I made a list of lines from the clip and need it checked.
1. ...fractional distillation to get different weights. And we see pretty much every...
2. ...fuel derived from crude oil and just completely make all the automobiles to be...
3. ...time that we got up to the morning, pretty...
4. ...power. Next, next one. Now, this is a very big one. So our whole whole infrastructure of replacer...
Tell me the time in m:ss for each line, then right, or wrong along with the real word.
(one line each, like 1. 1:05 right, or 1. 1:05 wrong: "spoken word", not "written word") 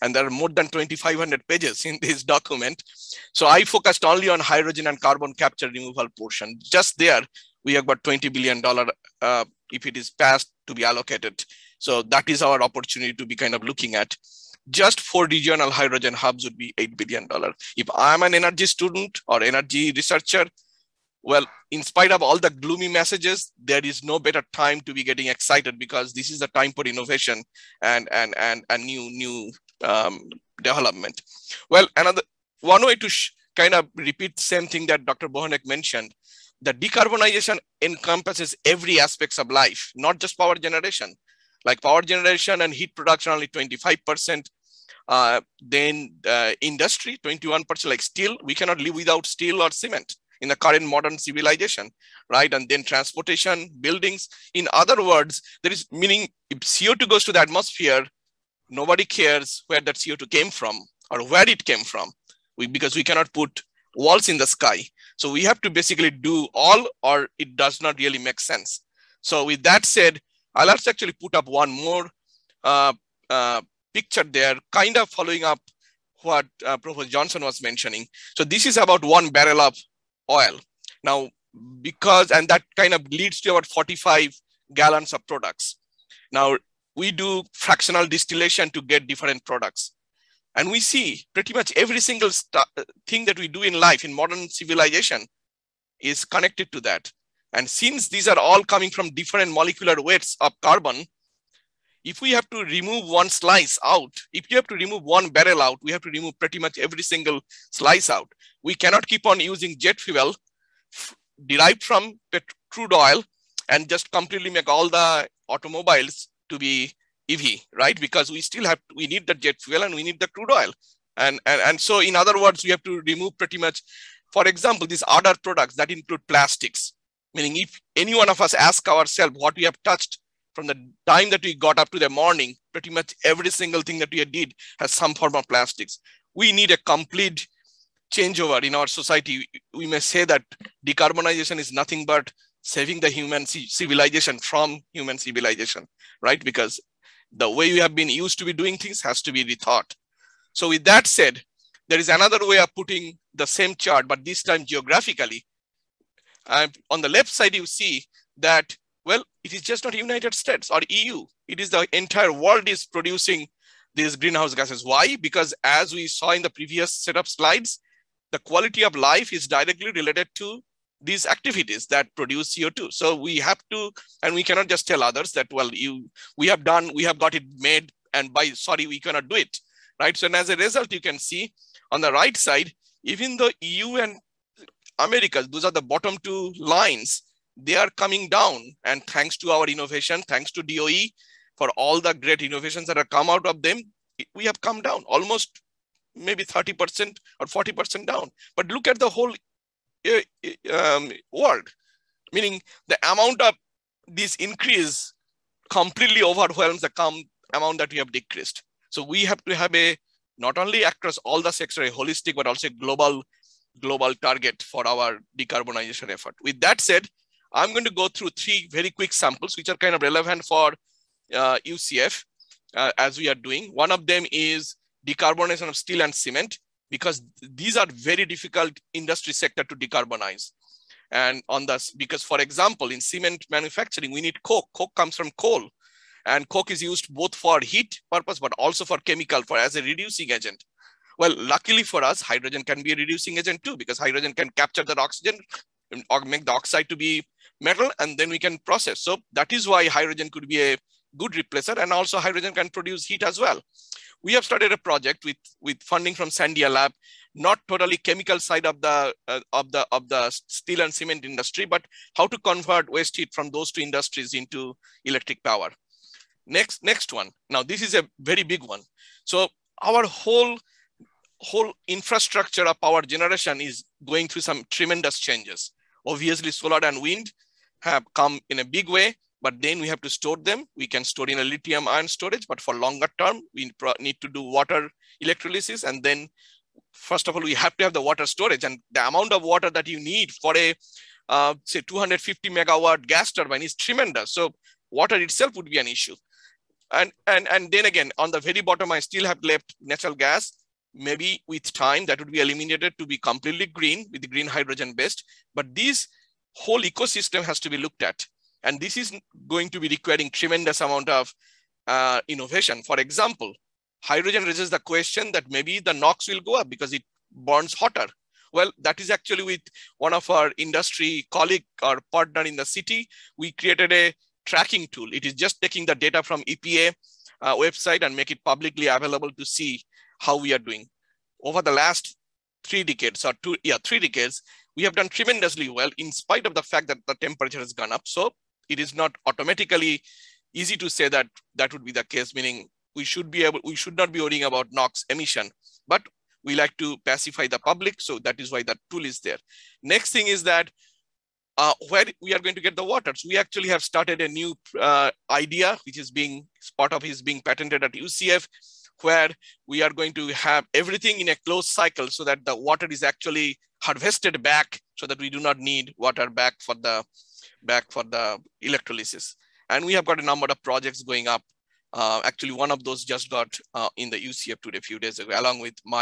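1. 1:27 wrong: "products", not "weights"
2. 1:49 right
3. 2:11 right
4. 4:25 wrong: "power", not "replacer".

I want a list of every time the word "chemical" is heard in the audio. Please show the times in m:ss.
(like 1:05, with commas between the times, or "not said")
3:58, 4:17.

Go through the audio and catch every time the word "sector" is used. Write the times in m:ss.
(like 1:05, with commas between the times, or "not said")
3:31, 3:49.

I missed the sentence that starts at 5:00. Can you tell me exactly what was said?
Maybe with time that would be eliminated to be completely green with the green hydrogen based.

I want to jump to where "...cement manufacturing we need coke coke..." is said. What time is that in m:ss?
3:52.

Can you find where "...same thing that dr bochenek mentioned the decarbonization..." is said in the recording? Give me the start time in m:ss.
0:34.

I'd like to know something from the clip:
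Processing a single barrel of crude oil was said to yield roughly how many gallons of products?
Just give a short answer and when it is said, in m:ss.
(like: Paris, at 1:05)
45 gallons, at 1:23.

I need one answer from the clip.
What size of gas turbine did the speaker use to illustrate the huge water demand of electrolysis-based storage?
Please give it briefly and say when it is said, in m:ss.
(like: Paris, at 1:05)
250 megawatt, at 4:51.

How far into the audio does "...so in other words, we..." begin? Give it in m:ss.
2:01.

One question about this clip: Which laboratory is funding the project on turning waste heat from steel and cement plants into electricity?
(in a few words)
Sandia Lab.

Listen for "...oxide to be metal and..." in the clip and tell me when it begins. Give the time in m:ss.
4:06.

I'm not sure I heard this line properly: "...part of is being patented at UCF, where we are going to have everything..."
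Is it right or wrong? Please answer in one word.
right.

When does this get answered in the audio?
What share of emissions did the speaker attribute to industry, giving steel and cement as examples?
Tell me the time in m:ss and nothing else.
0:47.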